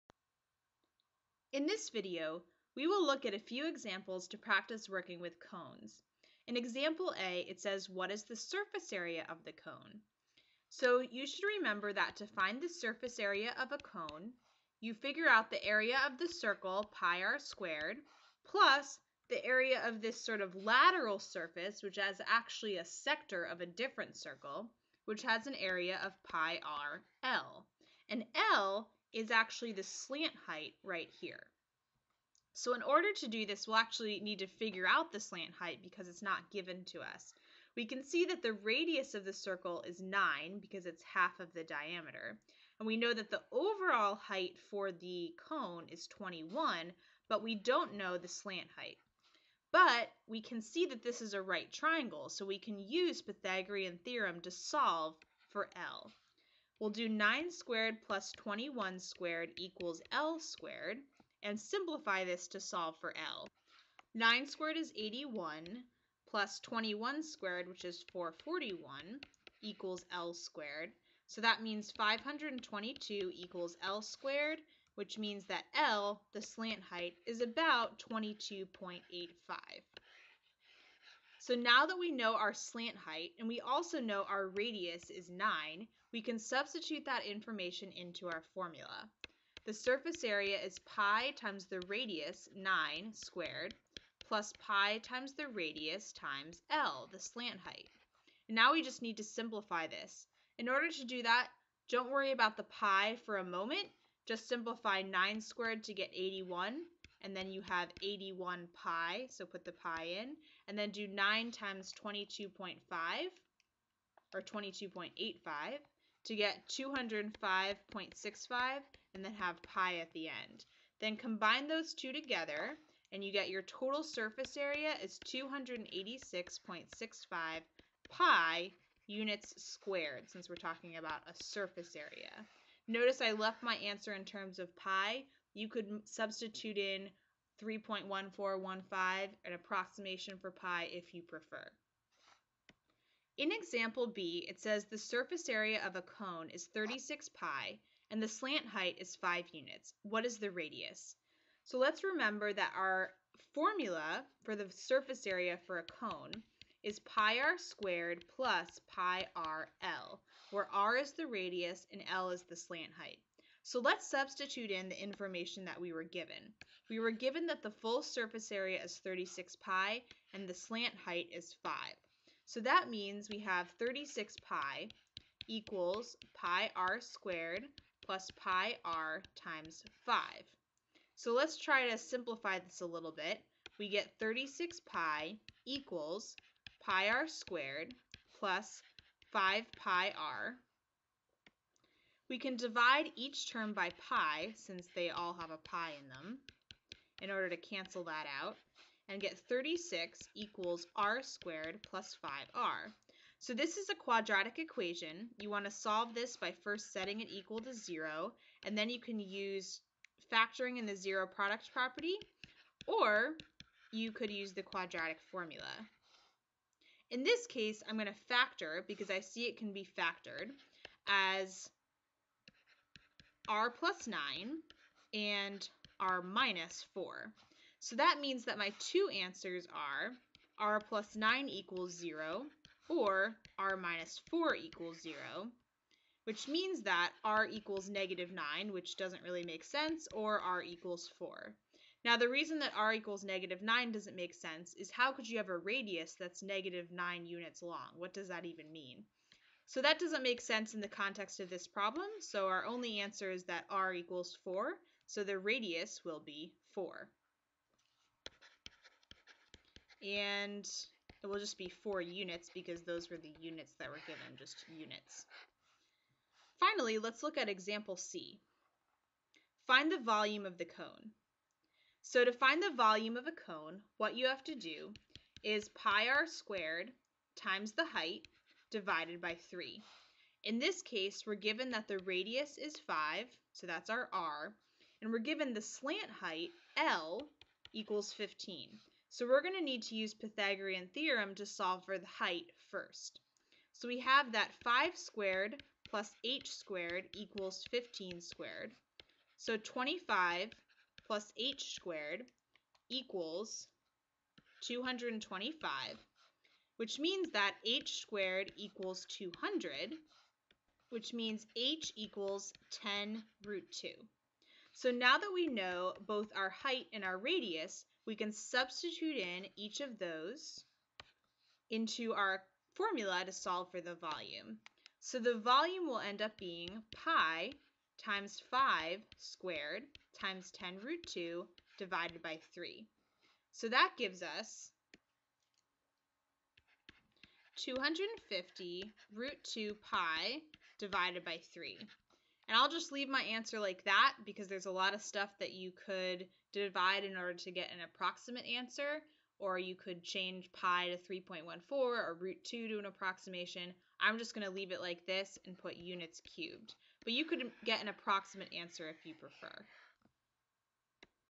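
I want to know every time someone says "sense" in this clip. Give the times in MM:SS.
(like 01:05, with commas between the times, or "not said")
03:59, 04:04, 04:10.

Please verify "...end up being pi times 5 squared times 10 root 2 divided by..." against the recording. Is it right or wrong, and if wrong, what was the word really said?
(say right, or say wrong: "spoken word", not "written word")
right.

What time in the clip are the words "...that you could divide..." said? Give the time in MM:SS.
05:45.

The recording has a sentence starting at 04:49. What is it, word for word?
So we're going to need to use Pythagorean theorem to solve for the height first.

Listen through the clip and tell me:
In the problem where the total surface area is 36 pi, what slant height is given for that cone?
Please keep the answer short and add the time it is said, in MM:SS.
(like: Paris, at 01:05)
5 units, at 02:29.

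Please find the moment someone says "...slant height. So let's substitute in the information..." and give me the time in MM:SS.
02:42.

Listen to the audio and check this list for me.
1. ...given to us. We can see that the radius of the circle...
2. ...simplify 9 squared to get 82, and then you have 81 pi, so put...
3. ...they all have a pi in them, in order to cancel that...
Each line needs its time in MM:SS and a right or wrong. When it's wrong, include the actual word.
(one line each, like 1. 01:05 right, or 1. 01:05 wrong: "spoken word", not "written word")
1. 00:36 right
2. 01:44 wrong: "81", not "82"
3. 03:14 right.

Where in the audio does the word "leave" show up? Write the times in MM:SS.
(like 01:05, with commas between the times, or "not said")
05:42, 05:54.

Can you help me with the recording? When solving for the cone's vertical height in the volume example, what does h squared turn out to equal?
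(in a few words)
200.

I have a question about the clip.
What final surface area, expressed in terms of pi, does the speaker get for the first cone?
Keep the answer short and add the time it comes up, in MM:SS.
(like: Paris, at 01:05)
286.65 pi, at 02:05.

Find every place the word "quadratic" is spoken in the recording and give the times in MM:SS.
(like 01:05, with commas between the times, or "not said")
03:23, 03:34.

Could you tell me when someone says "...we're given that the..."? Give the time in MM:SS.
04:41.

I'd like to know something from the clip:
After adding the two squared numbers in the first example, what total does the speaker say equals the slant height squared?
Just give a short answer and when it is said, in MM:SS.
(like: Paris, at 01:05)
522, at 01:11.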